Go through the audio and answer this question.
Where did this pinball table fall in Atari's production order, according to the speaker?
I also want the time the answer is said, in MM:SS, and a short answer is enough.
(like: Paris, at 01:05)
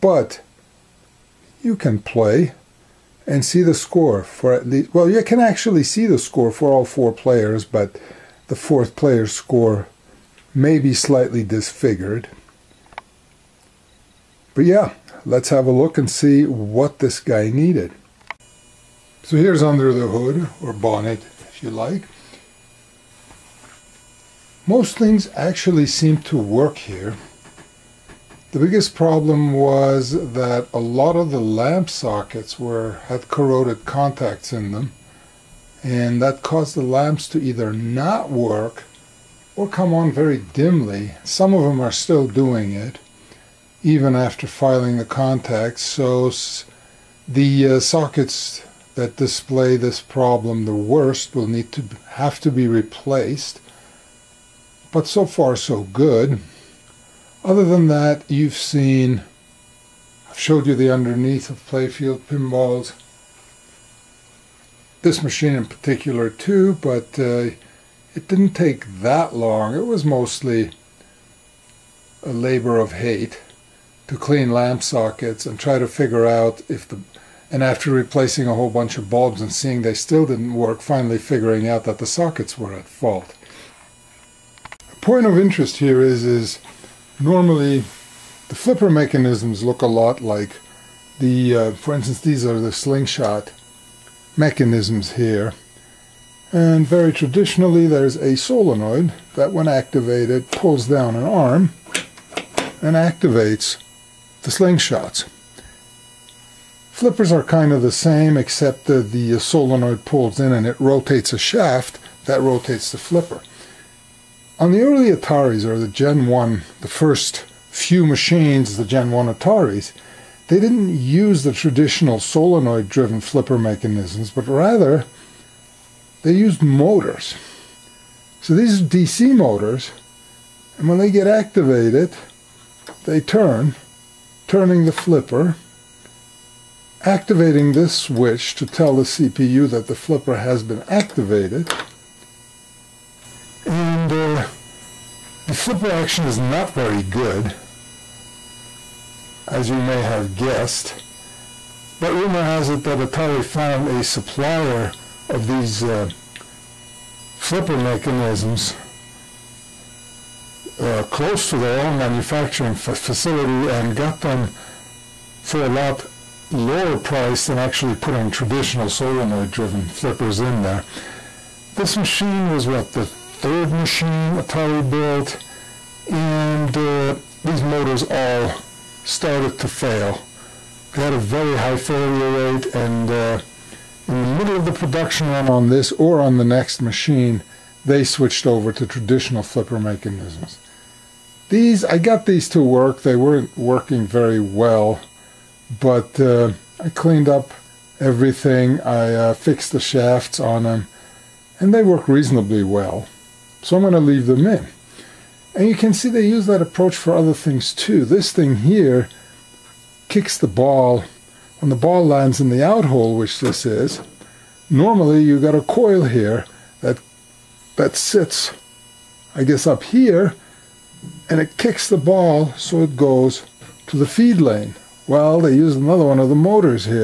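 The third, at 02:52.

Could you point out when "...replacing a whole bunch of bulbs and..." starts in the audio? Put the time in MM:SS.
01:17.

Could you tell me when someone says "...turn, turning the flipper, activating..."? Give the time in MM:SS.
02:13.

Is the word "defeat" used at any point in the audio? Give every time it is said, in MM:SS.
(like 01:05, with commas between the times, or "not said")
not said.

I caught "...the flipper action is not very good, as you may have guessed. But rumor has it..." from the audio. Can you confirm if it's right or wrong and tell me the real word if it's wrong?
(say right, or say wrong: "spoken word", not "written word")
right.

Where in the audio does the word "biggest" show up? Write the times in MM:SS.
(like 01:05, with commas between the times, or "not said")
00:28.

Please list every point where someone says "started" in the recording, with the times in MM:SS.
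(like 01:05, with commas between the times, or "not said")
02:59.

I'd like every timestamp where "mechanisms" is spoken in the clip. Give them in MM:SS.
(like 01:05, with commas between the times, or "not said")
01:28, 01:34, 02:03, 02:37, 03:09.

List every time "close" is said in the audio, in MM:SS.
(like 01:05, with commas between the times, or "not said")
02:41.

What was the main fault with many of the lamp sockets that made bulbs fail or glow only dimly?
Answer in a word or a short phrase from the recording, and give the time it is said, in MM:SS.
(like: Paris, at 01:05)
Corroded contacts, at 00:33.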